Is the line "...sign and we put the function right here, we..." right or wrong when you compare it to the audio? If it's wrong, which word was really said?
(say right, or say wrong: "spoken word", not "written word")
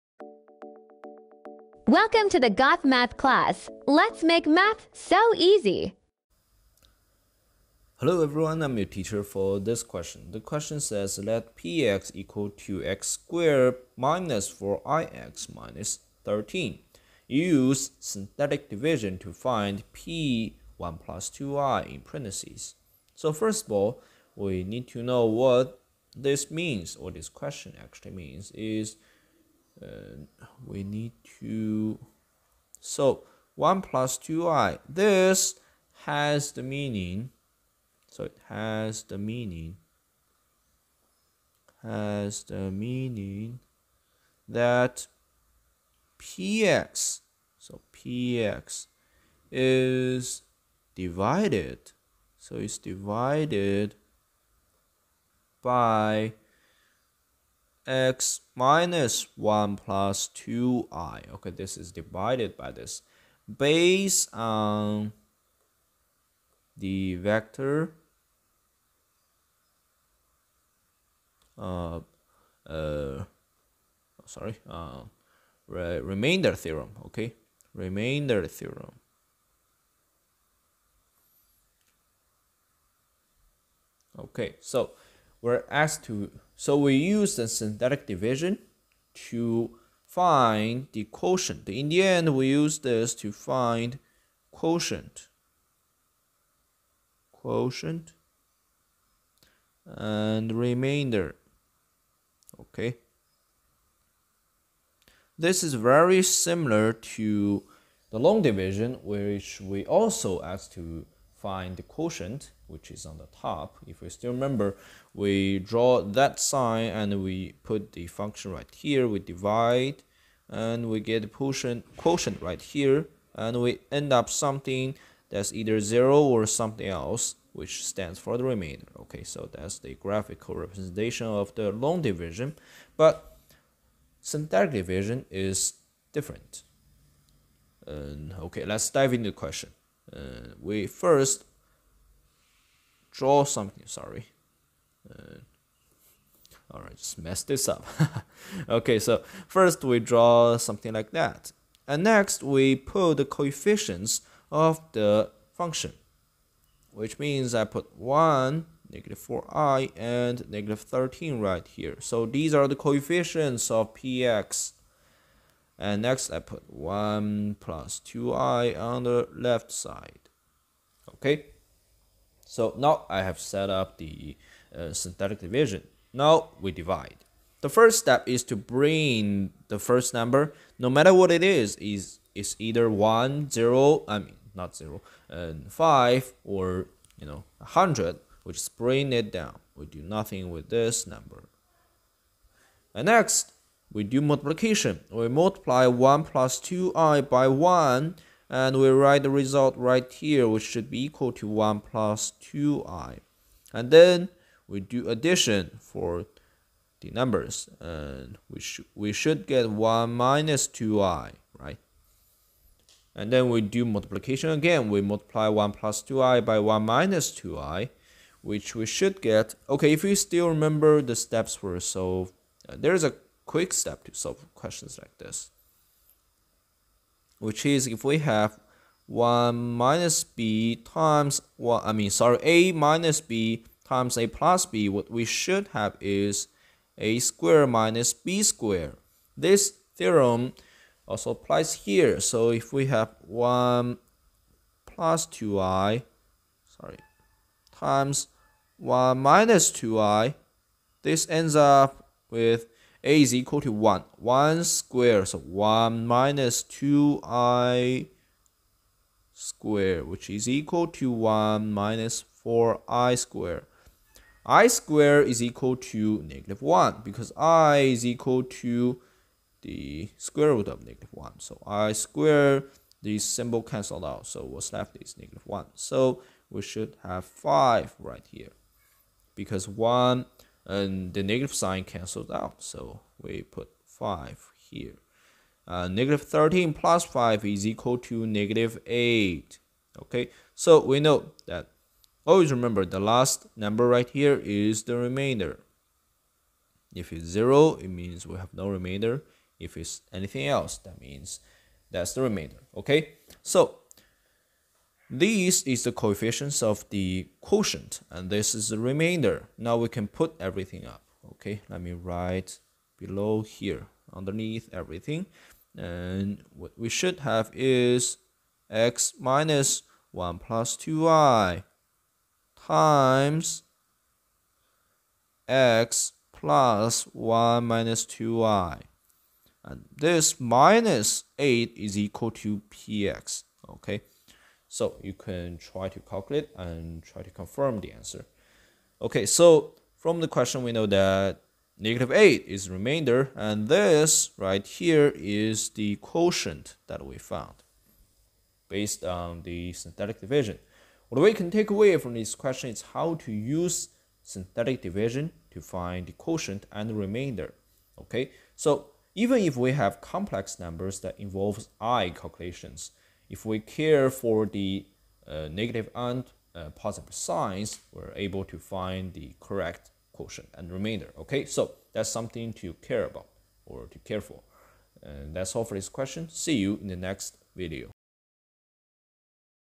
right.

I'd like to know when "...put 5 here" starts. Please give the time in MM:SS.
04:43.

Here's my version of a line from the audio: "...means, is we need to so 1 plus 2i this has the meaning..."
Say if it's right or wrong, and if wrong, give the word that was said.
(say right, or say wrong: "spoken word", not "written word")
right.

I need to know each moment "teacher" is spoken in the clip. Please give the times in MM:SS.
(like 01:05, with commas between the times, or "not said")
00:08.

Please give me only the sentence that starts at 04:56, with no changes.
If it's 0, it means we have no remainder.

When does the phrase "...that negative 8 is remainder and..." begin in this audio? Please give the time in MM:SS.
05:40.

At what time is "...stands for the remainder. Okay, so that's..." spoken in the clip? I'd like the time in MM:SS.
02:07.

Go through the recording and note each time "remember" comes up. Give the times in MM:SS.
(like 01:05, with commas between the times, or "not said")
01:54, 03:40, 04:52.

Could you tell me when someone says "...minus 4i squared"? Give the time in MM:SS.
04:21.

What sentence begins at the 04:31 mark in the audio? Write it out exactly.
So i squared, the symbol cancelled out, so what's left is negative 1.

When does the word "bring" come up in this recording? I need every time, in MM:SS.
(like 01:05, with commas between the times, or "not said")
02:58, 03:08.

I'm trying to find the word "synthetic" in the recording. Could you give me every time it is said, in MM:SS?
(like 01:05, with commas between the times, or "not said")
00:17, 01:27, 02:14, 02:54, 05:49, 05:54.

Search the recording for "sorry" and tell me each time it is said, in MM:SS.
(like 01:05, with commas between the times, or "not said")
01:14, 02:23, 03:52, 04:06.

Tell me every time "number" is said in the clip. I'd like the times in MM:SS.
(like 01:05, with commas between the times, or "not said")
03:00, 03:11, 03:27, 04:53, 06:00.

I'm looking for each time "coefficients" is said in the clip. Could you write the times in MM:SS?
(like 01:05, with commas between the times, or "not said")
02:33, 02:42, 05:05.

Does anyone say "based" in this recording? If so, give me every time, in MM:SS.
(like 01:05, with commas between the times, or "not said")
01:03, 05:48.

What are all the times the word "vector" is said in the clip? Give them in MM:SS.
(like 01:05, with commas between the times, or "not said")
01:07.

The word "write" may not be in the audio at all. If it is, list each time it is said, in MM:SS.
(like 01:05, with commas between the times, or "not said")
03:18, 05:11.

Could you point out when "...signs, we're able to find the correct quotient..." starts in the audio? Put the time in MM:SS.
06:07.